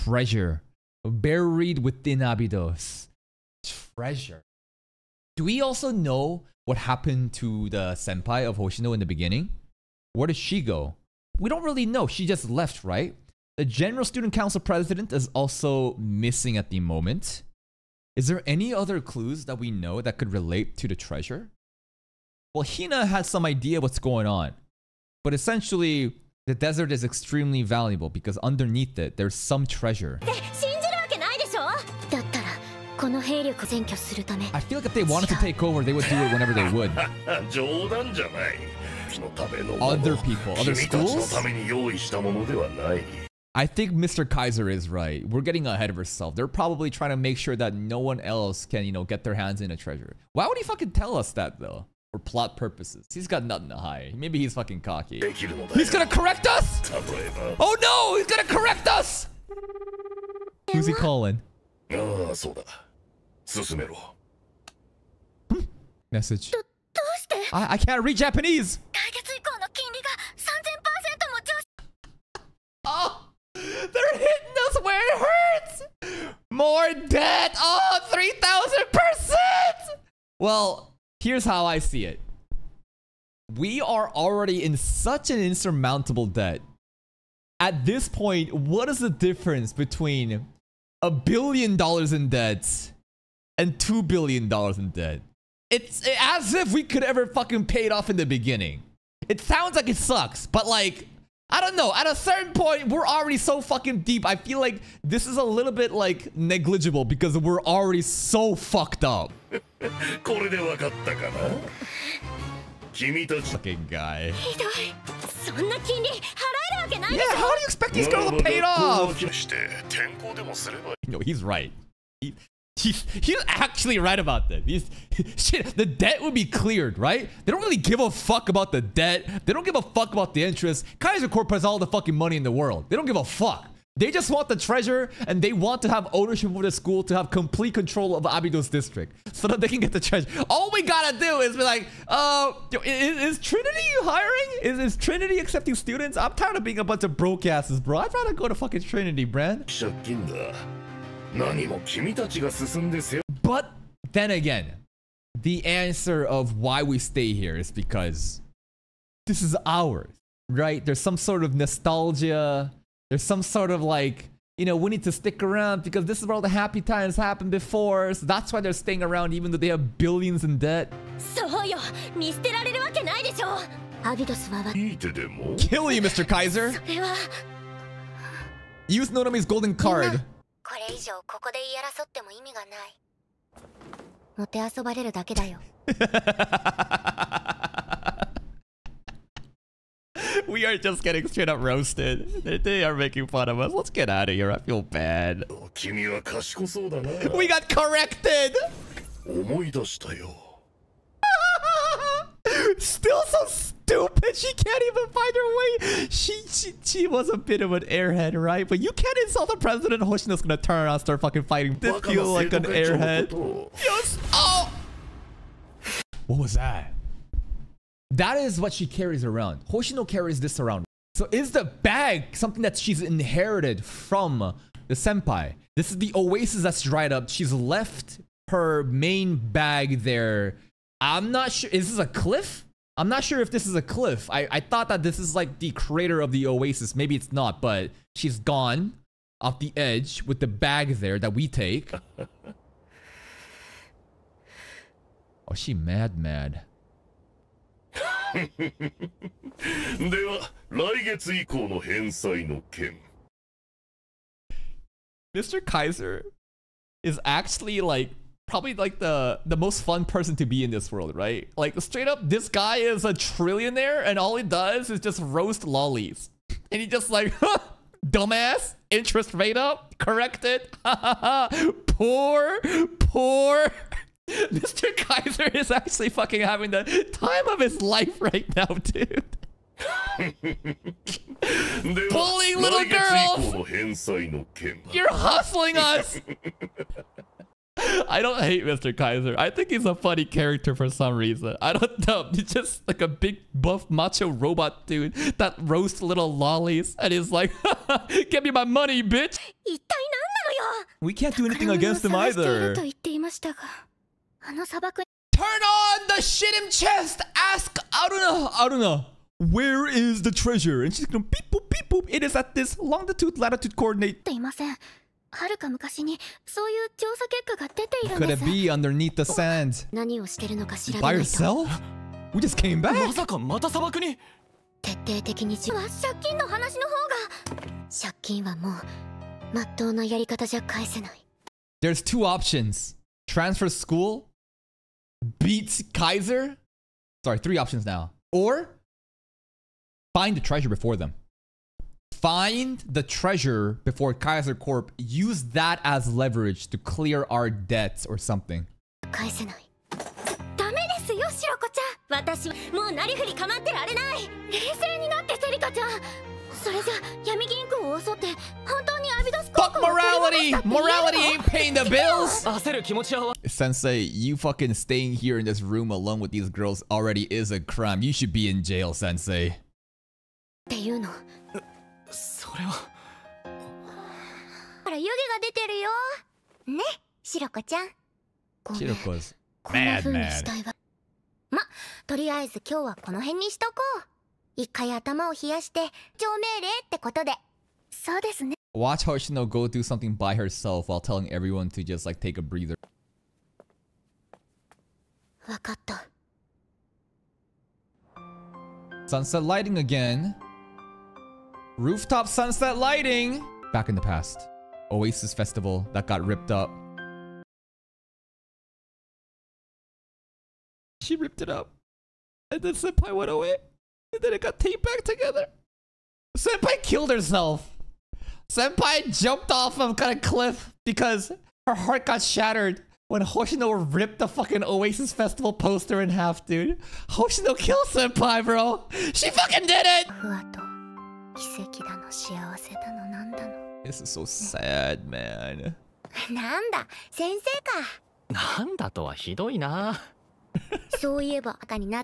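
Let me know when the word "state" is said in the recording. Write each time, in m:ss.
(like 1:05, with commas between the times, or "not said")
not said.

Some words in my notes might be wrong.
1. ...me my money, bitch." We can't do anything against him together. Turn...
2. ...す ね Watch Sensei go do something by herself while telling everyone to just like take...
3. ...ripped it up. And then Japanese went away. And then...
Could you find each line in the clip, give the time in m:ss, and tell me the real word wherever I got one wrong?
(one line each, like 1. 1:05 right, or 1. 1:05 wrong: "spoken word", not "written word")
1. 4:58 wrong: "either", not "together"
2. 6:28 wrong: "Hoshino", not "Sensei"
3. 6:51 wrong: "Senpai", not "Japanese".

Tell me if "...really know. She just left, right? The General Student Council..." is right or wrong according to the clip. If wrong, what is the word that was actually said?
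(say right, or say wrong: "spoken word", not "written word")
right.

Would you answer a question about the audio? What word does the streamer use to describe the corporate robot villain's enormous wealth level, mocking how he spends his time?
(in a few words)
trillionaire.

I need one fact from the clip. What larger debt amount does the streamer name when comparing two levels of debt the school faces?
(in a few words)
two billion dollars.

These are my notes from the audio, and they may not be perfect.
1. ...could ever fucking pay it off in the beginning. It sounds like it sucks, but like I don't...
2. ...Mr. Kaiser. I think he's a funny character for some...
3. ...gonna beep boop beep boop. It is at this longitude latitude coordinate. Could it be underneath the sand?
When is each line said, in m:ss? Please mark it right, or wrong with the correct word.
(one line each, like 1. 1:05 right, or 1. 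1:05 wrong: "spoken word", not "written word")
1. 1:36 right
2. 4:48 right
3. 5:11 right.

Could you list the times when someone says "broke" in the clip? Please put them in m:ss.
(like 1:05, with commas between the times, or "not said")
2:27.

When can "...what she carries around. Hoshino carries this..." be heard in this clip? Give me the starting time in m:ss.
3:38.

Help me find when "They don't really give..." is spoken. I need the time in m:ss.
2:07.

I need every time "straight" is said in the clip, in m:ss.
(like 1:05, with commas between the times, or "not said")
3:11, 4:21.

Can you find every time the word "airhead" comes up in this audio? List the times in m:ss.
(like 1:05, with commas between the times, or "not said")
3:27, 3:32.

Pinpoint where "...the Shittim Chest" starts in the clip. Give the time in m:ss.
5:06.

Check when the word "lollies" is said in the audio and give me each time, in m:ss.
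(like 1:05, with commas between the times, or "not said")
4:25, 4:56.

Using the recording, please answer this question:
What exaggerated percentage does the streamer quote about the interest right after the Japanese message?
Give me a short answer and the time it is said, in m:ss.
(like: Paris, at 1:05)
3,000%, at 1:18.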